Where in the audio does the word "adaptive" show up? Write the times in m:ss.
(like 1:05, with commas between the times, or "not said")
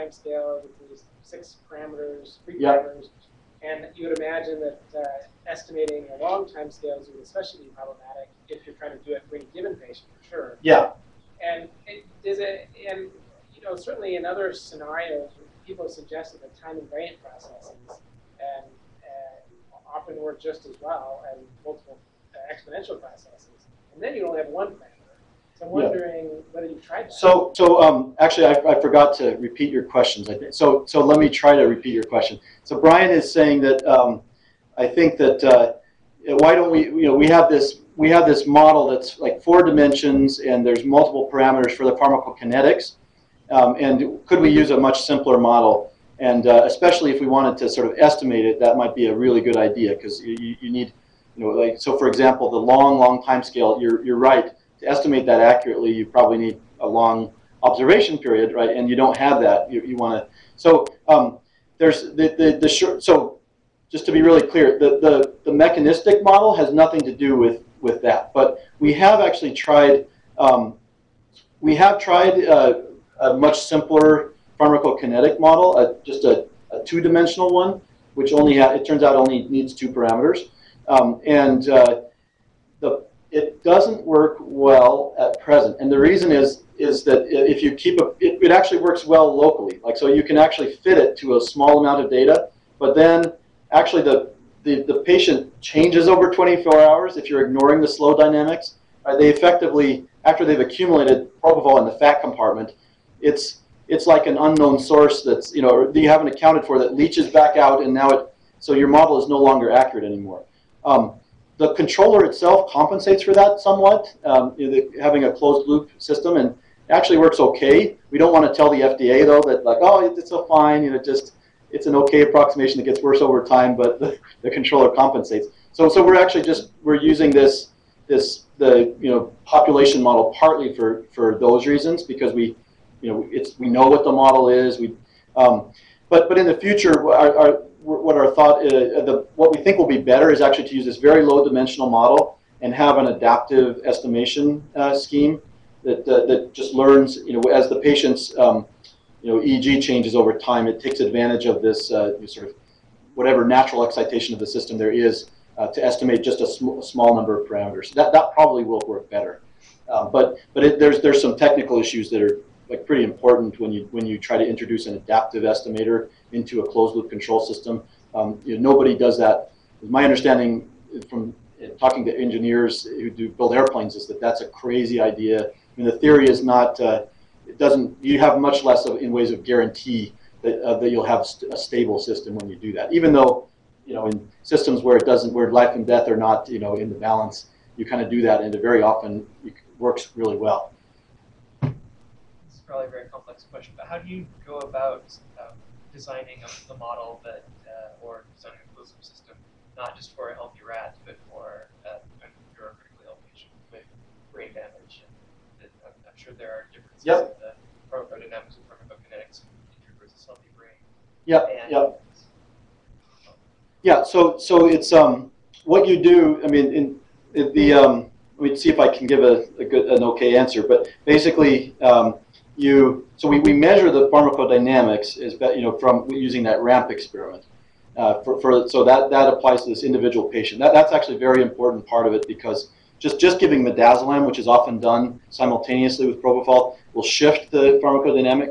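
2:23, 2:44.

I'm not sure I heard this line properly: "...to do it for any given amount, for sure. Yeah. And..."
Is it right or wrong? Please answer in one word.
wrong.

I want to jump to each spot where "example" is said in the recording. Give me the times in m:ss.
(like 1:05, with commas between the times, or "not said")
0:52.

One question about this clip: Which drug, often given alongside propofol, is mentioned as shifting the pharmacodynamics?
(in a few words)
midazolam.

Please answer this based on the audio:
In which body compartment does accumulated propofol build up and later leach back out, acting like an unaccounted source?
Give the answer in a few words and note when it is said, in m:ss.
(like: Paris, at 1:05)
fat compartment, at 1:41.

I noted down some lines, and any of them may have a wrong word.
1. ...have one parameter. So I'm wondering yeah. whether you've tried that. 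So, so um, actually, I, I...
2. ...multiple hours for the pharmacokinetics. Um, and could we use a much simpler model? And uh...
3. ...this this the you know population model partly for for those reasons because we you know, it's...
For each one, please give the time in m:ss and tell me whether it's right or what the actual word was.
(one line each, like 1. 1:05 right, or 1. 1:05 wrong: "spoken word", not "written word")
1. 0:24 right
2. 0:40 wrong: "parameters", not "hours"
3. 2:07 right.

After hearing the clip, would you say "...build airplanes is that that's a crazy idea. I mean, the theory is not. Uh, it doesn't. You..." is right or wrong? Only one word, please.
right.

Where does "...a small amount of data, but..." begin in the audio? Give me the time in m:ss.
1:31.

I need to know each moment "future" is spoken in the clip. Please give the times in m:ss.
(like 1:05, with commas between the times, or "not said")
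2:16.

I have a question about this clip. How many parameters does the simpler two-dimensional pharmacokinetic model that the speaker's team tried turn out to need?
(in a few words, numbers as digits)
2.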